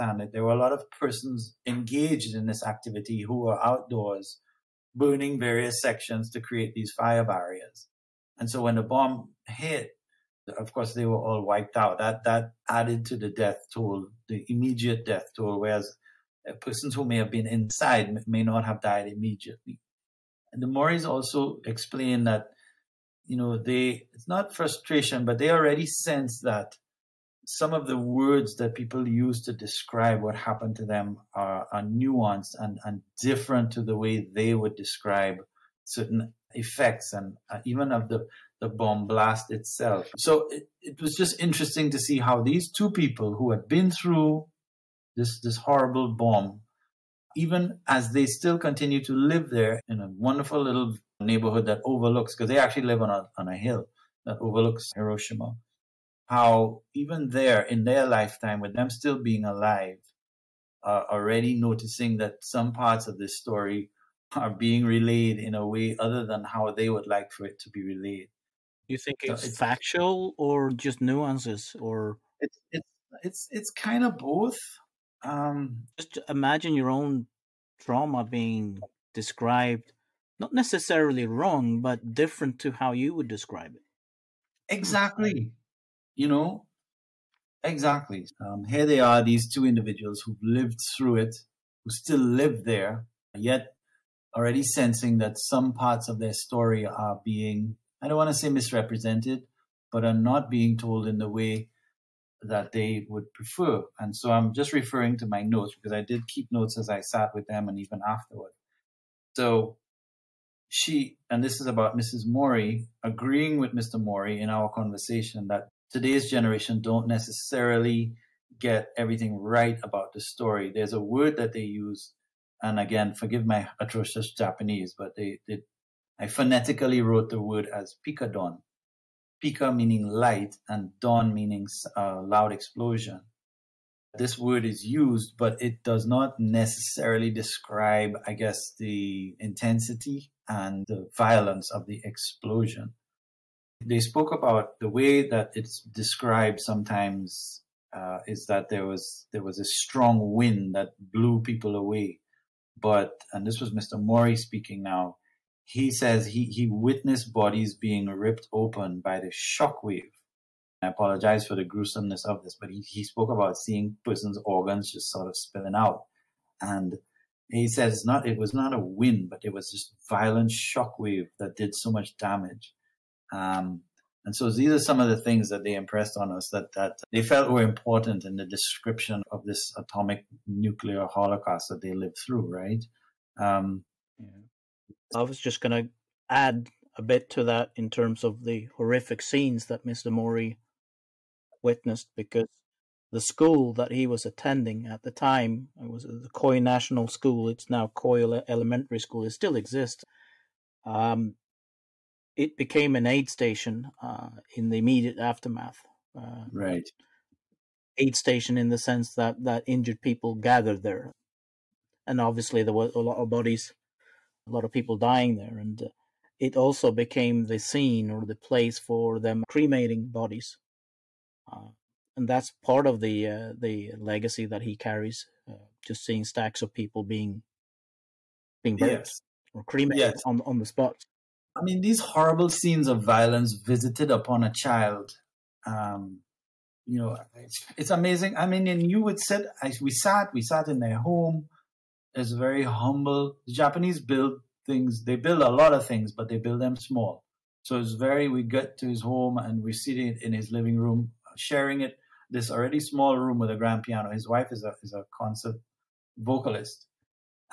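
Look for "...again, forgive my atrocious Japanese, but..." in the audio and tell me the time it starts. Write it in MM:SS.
02:02.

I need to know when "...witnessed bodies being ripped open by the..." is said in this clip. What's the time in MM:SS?
02:36.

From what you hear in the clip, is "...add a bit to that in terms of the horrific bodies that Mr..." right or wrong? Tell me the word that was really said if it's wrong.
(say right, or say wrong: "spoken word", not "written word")
wrong: "scenes", not "bodies".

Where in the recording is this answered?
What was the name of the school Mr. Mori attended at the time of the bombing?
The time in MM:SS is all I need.
03:16.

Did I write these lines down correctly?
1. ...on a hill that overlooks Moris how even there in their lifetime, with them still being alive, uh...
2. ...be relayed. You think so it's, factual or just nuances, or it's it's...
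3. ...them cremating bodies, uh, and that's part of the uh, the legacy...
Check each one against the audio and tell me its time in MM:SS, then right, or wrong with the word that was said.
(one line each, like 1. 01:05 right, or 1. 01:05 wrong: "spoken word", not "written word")
1. 00:53 wrong: "Hiroshima", not "Moris"
2. 01:07 right
3. 03:39 right.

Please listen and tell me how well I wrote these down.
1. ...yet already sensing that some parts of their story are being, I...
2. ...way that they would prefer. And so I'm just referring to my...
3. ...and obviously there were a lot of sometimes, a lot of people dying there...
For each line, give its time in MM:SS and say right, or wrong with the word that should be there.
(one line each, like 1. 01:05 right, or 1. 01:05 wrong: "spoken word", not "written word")
1. 01:33 right
2. 01:41 right
3. 03:32 wrong: "bodies", not "sometimes".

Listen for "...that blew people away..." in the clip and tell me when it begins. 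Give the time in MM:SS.
02:30.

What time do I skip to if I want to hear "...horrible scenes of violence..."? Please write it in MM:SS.
03:51.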